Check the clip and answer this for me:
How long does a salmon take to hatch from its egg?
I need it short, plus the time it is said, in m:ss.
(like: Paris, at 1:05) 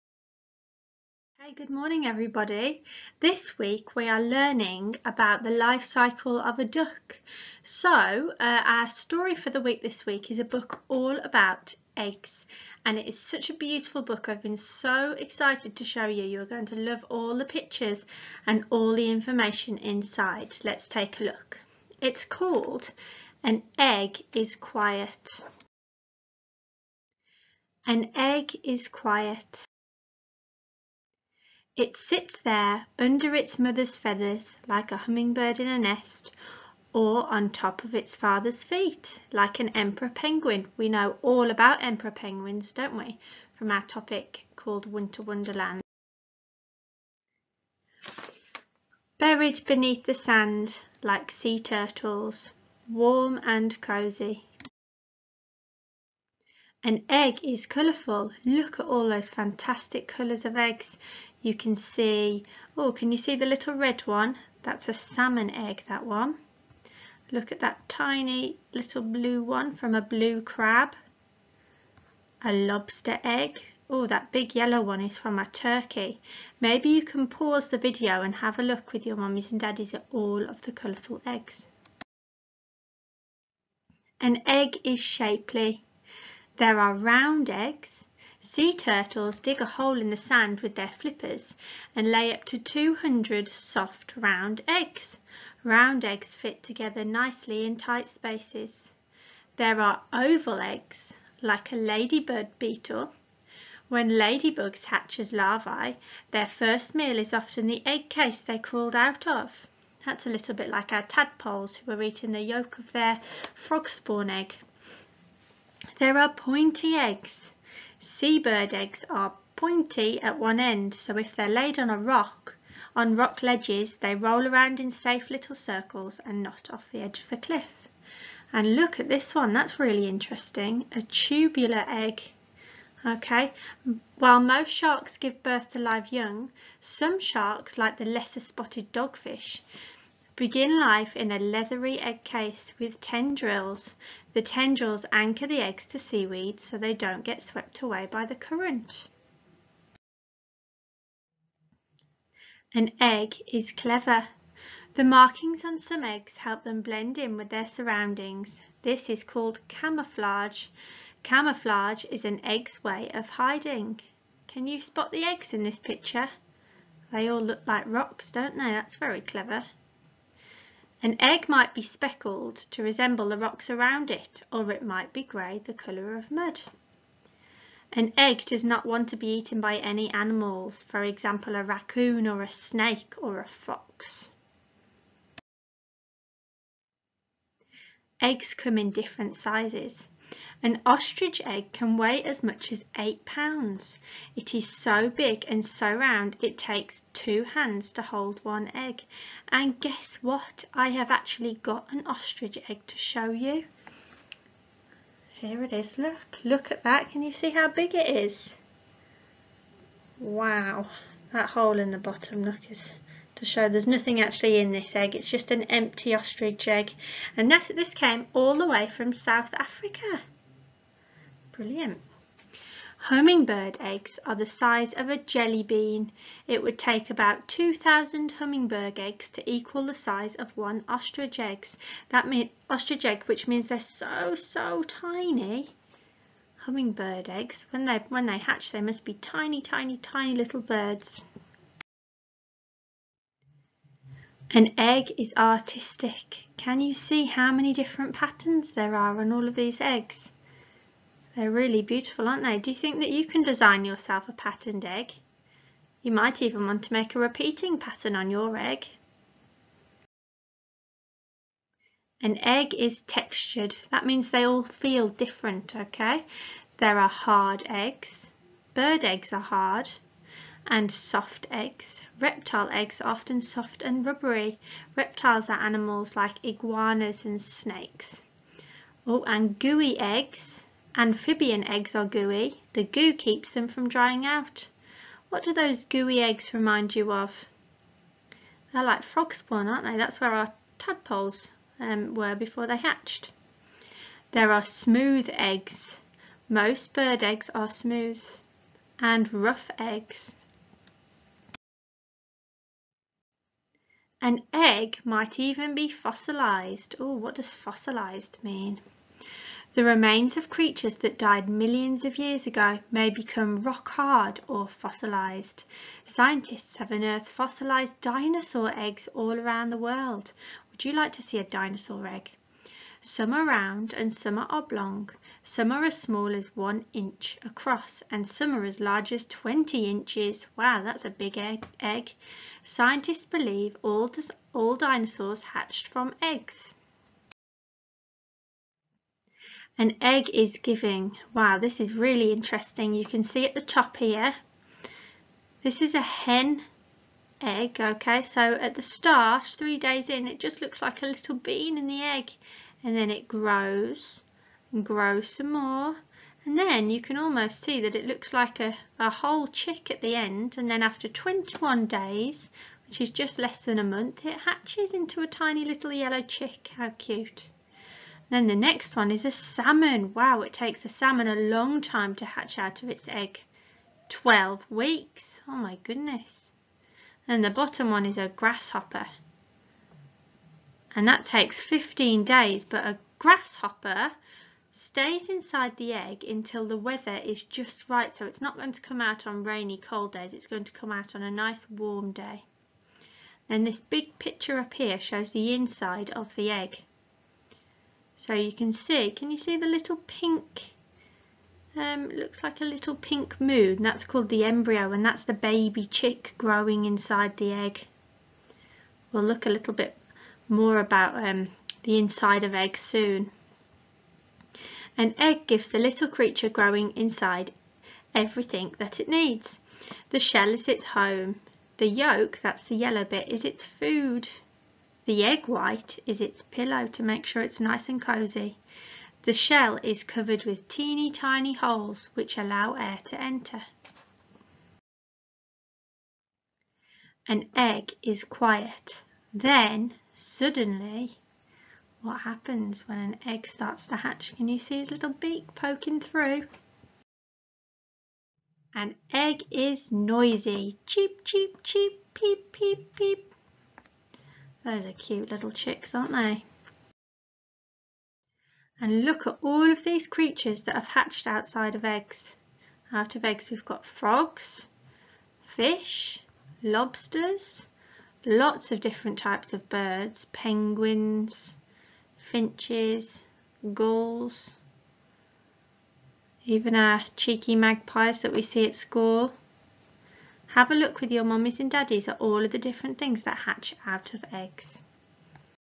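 12 weeks, at 6:14.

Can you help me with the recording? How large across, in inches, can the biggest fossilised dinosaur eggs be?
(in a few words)
20 inches.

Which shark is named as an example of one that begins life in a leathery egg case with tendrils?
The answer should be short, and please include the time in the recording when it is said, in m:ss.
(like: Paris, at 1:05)
lesser spotted dogfish, at 2:18.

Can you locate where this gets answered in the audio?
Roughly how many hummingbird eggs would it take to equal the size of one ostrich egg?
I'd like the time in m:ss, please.
3:47.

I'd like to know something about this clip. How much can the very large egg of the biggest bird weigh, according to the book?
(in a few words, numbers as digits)
8 pounds.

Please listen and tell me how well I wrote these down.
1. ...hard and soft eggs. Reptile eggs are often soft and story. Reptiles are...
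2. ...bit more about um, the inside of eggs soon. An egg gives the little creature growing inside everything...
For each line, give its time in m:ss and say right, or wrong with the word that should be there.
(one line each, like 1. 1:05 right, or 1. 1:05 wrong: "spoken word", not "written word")
1. 4:29 wrong: "rubbery", not "story"
2. 6:49 right.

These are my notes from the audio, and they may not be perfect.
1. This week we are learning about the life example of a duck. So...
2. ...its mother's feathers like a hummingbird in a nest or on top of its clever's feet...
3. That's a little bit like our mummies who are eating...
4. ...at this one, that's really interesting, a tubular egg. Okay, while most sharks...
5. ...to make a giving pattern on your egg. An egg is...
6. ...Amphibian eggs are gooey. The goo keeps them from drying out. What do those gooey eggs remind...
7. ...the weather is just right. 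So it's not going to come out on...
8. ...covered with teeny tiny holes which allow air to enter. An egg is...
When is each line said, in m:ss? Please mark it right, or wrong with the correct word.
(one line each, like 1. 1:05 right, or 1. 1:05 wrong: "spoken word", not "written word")
1. 0:03 wrong: "cycle", not "example"
2. 0:33 wrong: "father", not "clever"
3. 1:50 wrong: "tadpoles", not "mummies"
4. 2:08 right
5. 4:16 wrong: "repeating", not "giving"
6. 4:40 right
7. 6:26 right
8. 7:10 right.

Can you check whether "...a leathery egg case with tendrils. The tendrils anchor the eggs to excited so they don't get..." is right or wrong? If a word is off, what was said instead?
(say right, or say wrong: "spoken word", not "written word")
wrong: "seaweed", not "excited".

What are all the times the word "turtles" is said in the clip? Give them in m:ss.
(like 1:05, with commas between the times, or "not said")
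0:51, 1:28.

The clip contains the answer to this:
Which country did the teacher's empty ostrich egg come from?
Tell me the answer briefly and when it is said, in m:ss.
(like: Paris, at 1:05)
South Africa, at 3:39.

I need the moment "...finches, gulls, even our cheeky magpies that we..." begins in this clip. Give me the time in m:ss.
7:52.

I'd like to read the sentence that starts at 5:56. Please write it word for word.
And then you can almost see that it looks like a, a whole chick at the end.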